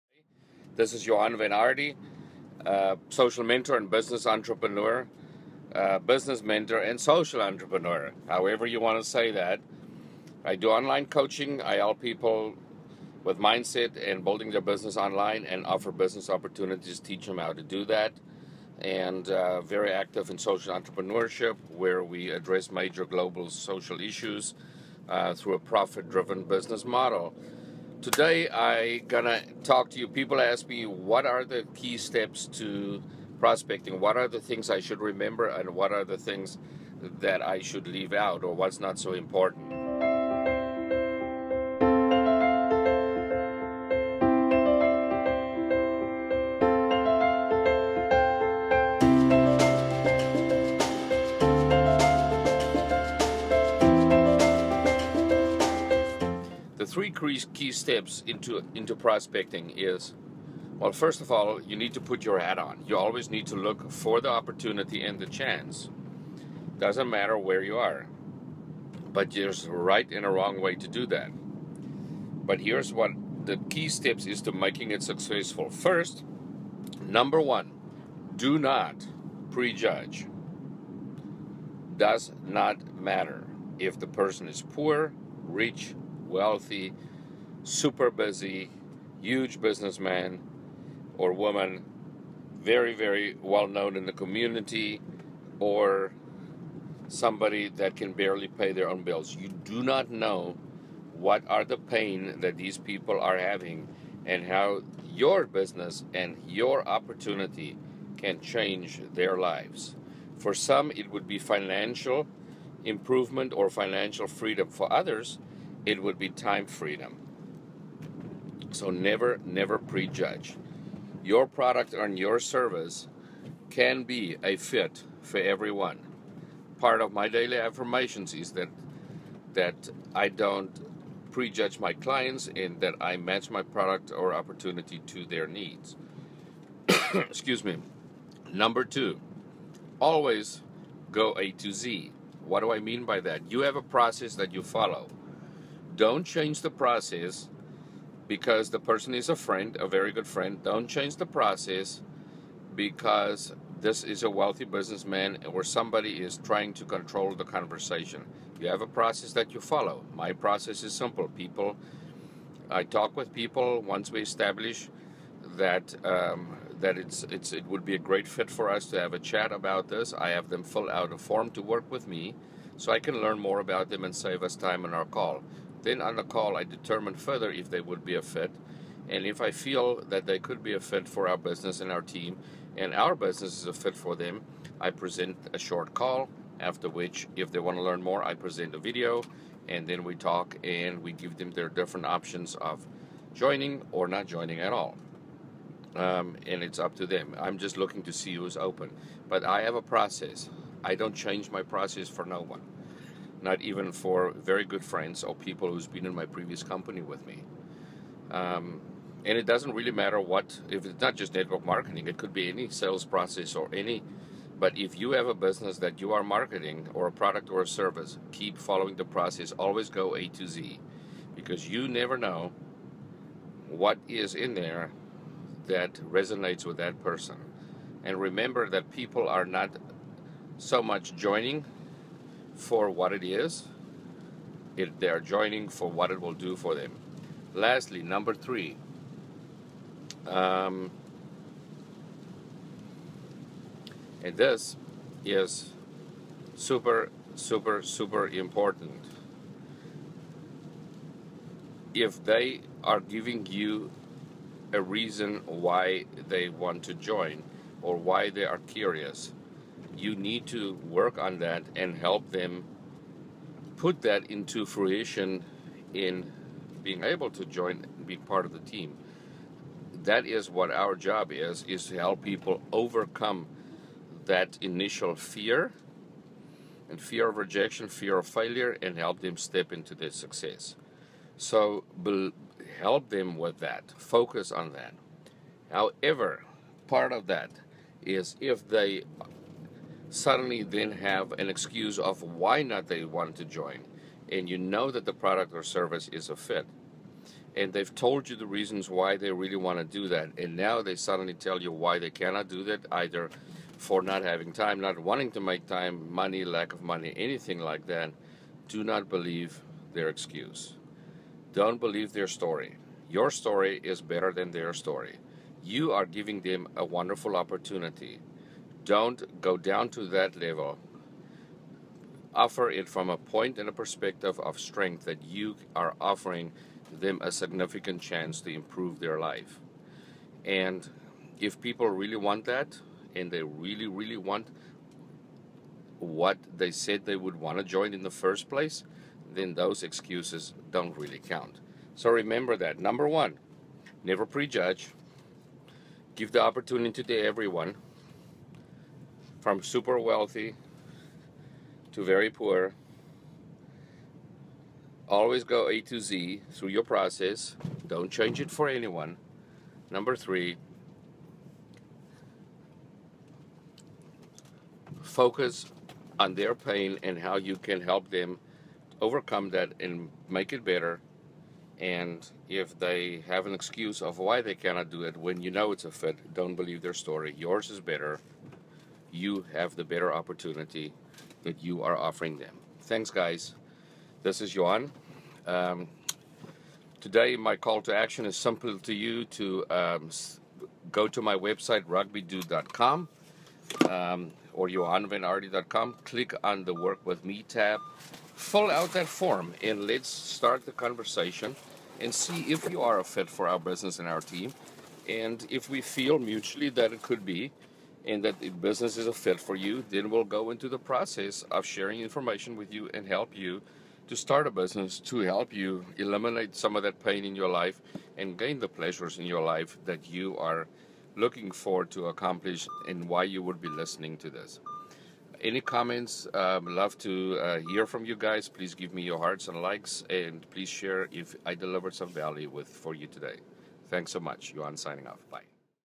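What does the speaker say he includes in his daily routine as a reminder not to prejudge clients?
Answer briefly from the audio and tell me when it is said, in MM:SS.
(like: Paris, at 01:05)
Daily affirmations, at 02:07.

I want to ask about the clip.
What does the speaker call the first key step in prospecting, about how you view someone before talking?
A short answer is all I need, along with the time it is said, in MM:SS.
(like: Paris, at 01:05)
Do not prejudge, at 01:18.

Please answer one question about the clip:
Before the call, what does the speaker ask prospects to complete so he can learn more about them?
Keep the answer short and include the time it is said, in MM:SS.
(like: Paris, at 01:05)
A form, at 02:51.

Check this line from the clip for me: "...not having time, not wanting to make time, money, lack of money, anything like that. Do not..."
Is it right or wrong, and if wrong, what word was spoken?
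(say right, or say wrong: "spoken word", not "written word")
right.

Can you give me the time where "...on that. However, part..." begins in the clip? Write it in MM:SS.
04:44.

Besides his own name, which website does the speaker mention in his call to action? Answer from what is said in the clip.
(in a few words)
rugbydude.com.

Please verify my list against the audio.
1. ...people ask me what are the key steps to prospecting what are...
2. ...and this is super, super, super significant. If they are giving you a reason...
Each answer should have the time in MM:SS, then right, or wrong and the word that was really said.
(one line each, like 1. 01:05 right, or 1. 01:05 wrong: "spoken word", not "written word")
1. 00:30 right
2. 04:04 wrong: "important", not "significant".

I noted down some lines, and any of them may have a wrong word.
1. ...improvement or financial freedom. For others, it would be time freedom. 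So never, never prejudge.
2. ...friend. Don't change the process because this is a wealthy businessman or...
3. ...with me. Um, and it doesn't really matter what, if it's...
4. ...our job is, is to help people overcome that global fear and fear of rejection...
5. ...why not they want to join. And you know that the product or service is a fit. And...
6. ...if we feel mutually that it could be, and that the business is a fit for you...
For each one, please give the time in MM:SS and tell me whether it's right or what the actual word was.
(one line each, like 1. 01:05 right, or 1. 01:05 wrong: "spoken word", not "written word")
1. 01:52 right
2. 02:30 right
3. 03:27 right
4. 04:30 wrong: "initial", not "global"
5. 04:52 right
6. 06:45 right.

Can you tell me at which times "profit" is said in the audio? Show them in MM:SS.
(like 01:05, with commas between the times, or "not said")
00:25.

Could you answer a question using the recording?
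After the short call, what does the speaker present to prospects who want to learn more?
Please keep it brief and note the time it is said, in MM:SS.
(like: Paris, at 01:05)
A video, at 03:08.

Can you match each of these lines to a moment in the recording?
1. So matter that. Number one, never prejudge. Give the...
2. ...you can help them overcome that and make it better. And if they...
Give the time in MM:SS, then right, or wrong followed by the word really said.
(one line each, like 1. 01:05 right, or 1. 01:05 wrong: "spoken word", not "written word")
1. 05:41 wrong: "remember", not "matter"
2. 06:07 right.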